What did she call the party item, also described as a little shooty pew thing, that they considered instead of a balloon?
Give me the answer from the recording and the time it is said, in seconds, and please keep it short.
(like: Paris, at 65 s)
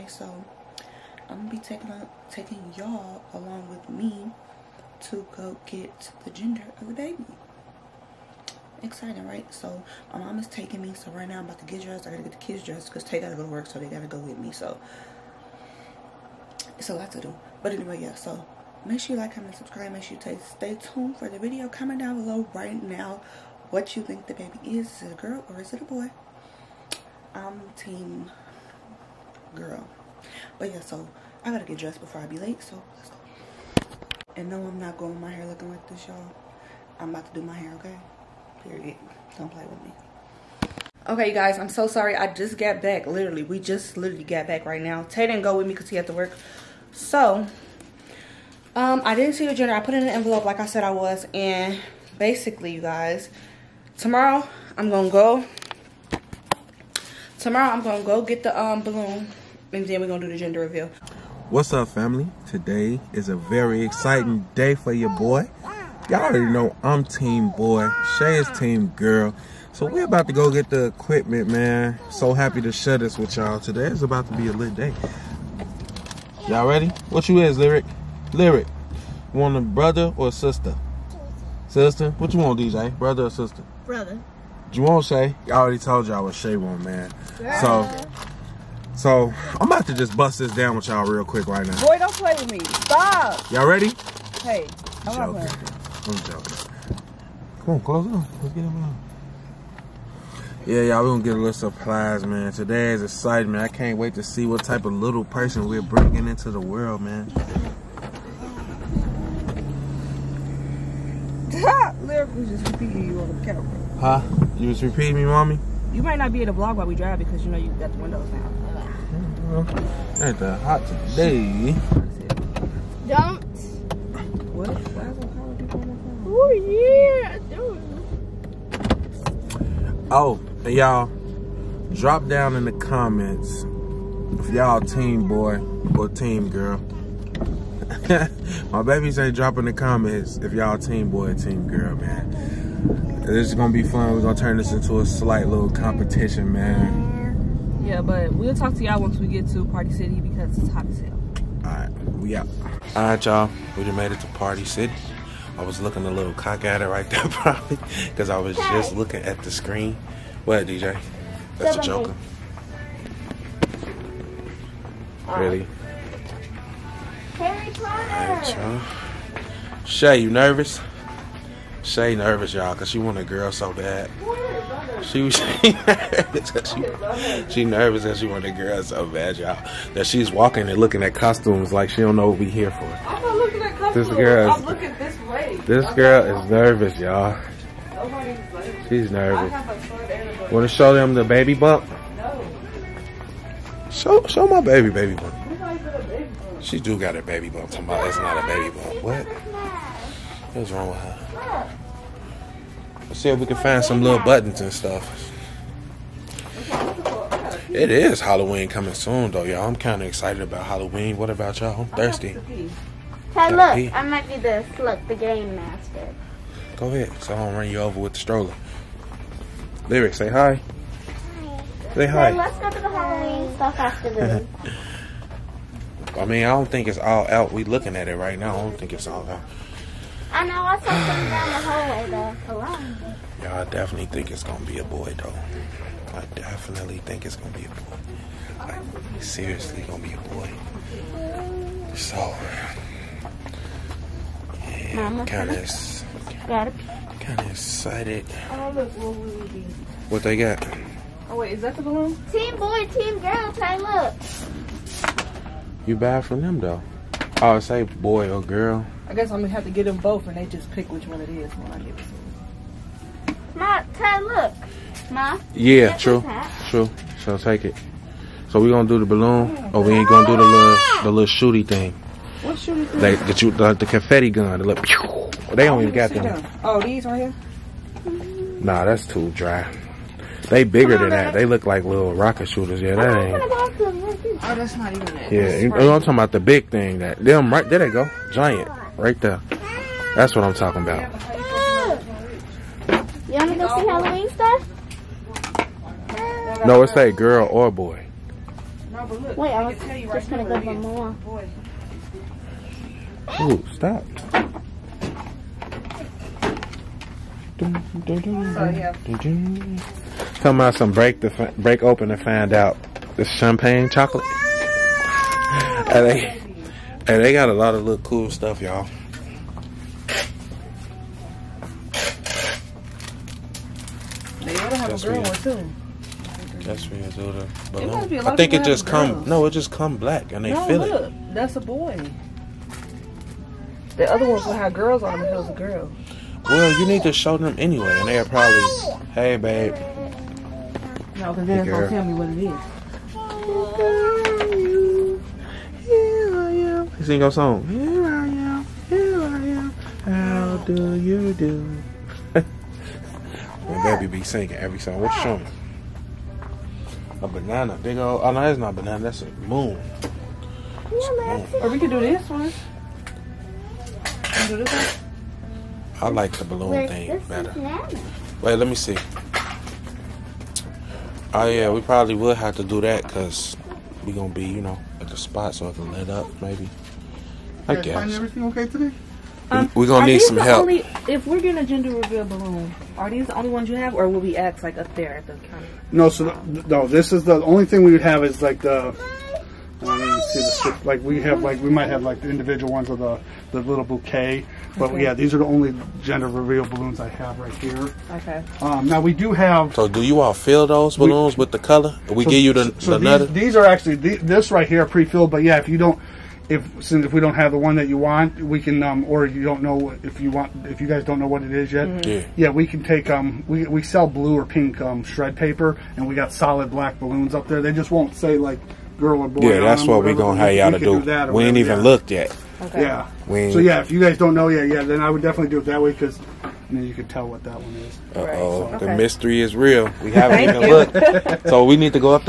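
Confetti gun, at 273 s.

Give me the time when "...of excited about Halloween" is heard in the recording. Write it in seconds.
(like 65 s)
210 s.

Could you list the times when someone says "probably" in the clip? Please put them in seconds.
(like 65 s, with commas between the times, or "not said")
157 s, 338 s, 371 s.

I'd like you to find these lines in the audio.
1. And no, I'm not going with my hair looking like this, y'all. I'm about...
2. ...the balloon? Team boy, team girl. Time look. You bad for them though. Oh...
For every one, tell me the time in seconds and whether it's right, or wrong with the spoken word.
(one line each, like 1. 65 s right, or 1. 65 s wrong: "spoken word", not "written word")
1. 34 s right
2. 251 s right.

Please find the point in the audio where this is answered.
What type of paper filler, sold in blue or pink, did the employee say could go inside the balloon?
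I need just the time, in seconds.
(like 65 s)
415 s.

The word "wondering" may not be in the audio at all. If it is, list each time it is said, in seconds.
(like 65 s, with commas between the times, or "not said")
not said.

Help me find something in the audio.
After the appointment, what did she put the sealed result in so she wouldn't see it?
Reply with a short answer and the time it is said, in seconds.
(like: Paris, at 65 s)
An envelope, at 50 s.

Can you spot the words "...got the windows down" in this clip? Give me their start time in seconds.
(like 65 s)
117 s.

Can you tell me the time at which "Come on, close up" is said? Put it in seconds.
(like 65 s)
97 s.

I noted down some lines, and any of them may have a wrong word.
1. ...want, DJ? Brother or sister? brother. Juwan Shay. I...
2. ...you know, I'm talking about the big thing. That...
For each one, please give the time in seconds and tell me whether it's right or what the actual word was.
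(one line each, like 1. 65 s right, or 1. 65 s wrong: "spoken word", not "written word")
1. 82 s right
2. 285 s right.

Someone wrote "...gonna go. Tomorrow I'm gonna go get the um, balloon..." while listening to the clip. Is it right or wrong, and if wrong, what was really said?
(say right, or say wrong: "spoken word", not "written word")
right.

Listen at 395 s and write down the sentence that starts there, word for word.
yeah, these are the only gender reveal balloons I have right here.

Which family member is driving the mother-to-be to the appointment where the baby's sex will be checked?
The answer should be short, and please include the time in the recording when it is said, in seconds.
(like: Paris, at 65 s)
My mom, at 10 s.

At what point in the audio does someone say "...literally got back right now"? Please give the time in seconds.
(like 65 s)
43 s.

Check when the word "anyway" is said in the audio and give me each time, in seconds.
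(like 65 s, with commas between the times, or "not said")
17 s, 337 s.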